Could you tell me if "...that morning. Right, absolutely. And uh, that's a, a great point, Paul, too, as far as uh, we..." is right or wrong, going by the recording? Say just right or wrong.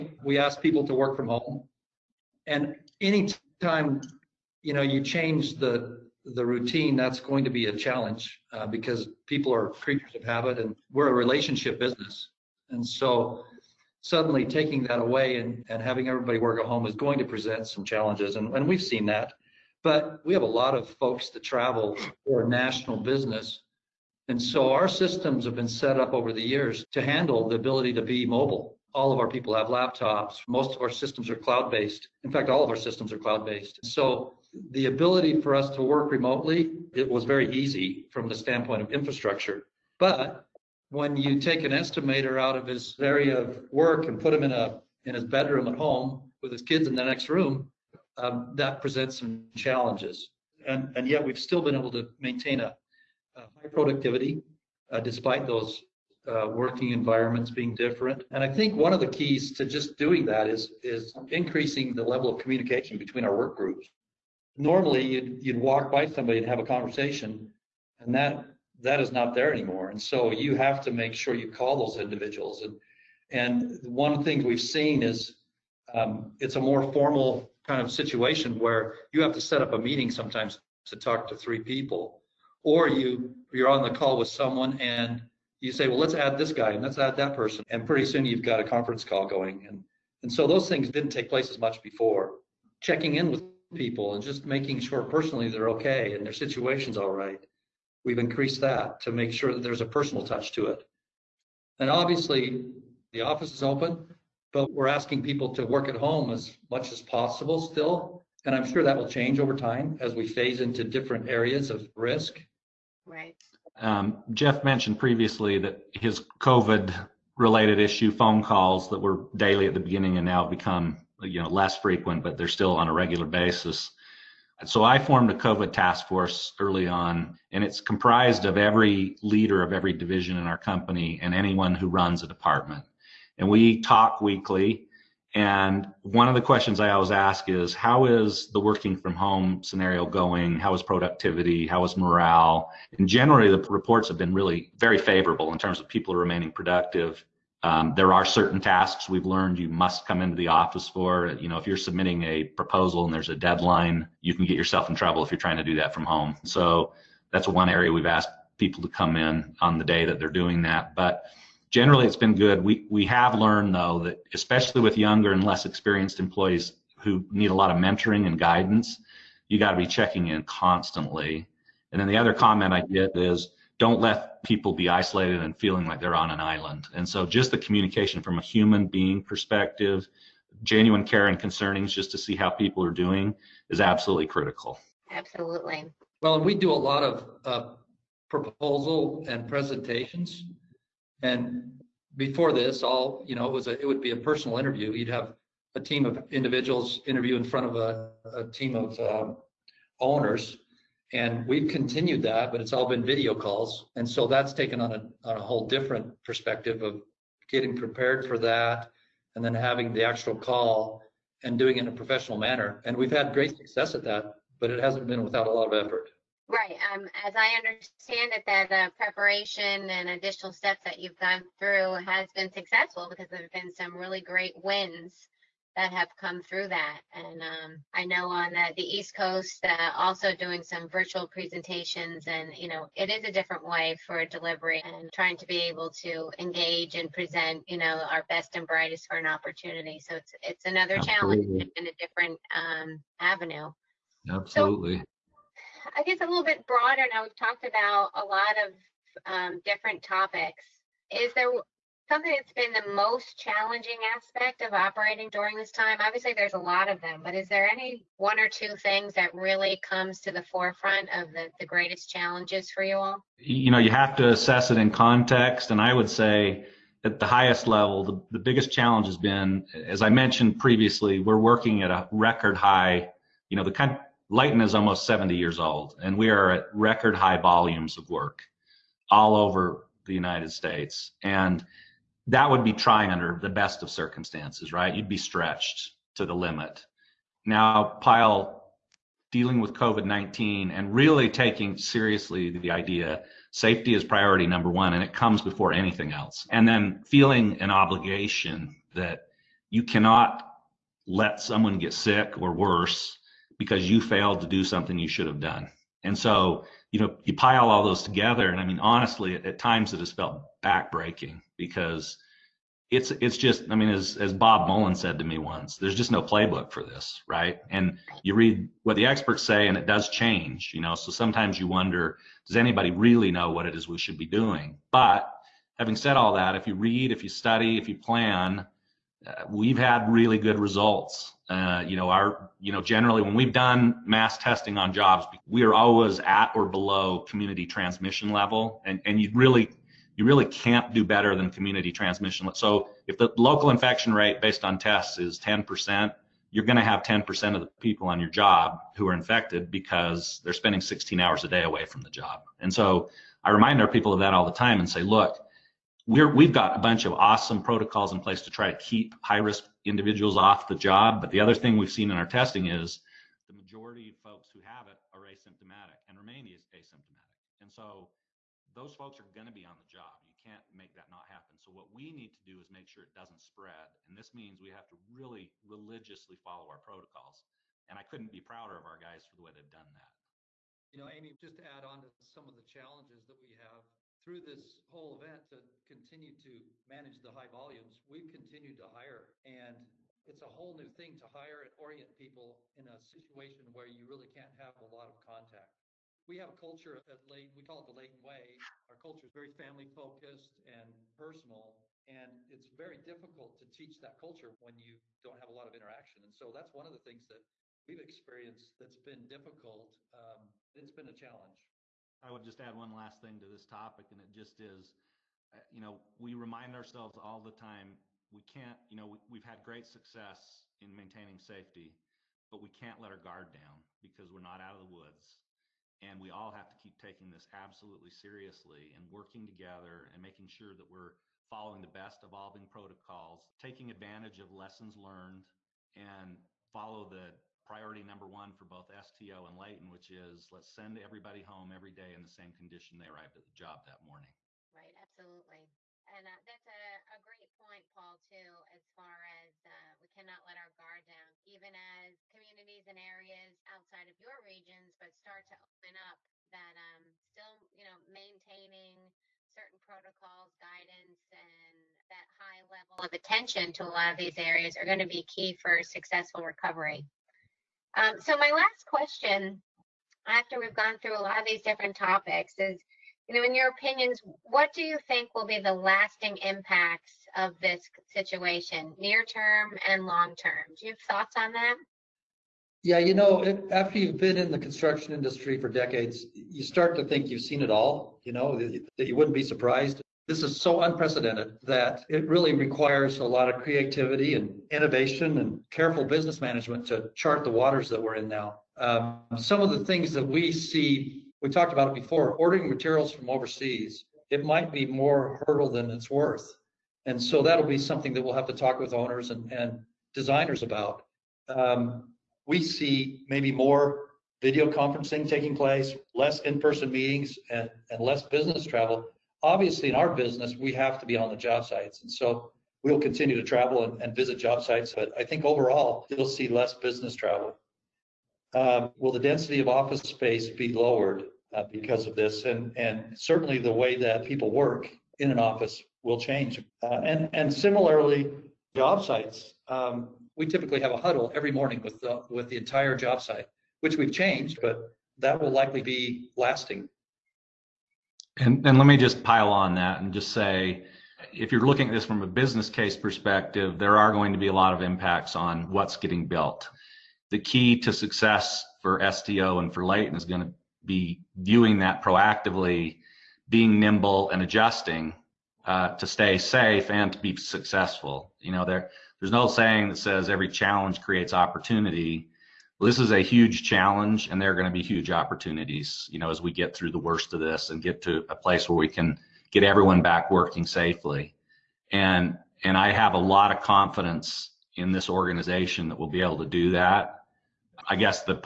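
right.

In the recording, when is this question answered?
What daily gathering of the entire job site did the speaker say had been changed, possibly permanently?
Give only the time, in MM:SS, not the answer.
09:00.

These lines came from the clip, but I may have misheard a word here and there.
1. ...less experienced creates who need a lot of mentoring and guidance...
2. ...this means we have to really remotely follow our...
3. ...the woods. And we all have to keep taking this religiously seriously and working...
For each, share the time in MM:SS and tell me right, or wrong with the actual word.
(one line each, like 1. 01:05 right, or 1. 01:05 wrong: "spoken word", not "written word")
1. 02:45 wrong: "employees", not "creates"
2. 06:14 wrong: "religiously", not "remotely"
3. 07:04 wrong: "absolutely", not "religiously".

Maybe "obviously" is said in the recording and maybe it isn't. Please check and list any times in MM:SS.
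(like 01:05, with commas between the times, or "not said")
01:41, 04:15, 08:39.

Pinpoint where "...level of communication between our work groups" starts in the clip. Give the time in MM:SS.
01:02.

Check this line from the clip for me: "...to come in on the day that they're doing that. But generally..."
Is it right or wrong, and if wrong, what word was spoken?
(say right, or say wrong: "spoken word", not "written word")
right.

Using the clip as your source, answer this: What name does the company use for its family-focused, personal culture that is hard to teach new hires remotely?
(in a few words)
The Layton Way.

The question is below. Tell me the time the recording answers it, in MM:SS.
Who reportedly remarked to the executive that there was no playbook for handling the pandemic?
05:14.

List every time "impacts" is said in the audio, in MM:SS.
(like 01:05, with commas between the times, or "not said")
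07:56, 09:14.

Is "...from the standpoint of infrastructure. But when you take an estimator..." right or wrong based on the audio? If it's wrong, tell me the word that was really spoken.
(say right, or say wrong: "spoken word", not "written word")
right.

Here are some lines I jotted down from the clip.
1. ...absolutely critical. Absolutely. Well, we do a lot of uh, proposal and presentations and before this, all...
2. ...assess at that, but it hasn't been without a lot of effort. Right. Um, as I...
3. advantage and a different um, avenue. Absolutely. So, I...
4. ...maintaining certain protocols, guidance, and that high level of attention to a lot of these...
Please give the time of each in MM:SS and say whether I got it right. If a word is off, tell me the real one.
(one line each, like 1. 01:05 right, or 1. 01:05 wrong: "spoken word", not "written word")
1. 03:03 right
2. 03:33 wrong: "success", not "assess"
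3. 04:01 wrong: "challenge", not "advantage"
4. 07:38 right.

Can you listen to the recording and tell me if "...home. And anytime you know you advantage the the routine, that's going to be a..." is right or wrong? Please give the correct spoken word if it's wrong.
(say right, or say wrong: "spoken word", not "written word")
wrong: "change", not "advantage".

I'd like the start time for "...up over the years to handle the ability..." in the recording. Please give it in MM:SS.
00:25.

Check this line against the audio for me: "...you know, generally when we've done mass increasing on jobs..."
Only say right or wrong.
wrong.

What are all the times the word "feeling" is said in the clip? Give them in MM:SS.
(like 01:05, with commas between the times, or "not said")
02:55, 04:57.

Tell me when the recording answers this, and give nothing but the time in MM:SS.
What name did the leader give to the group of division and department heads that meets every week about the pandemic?
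02:05.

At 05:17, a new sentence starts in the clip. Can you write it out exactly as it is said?
And you read what the experts say, and it does change, you know.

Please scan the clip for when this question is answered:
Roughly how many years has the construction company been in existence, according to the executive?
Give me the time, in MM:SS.
04:34.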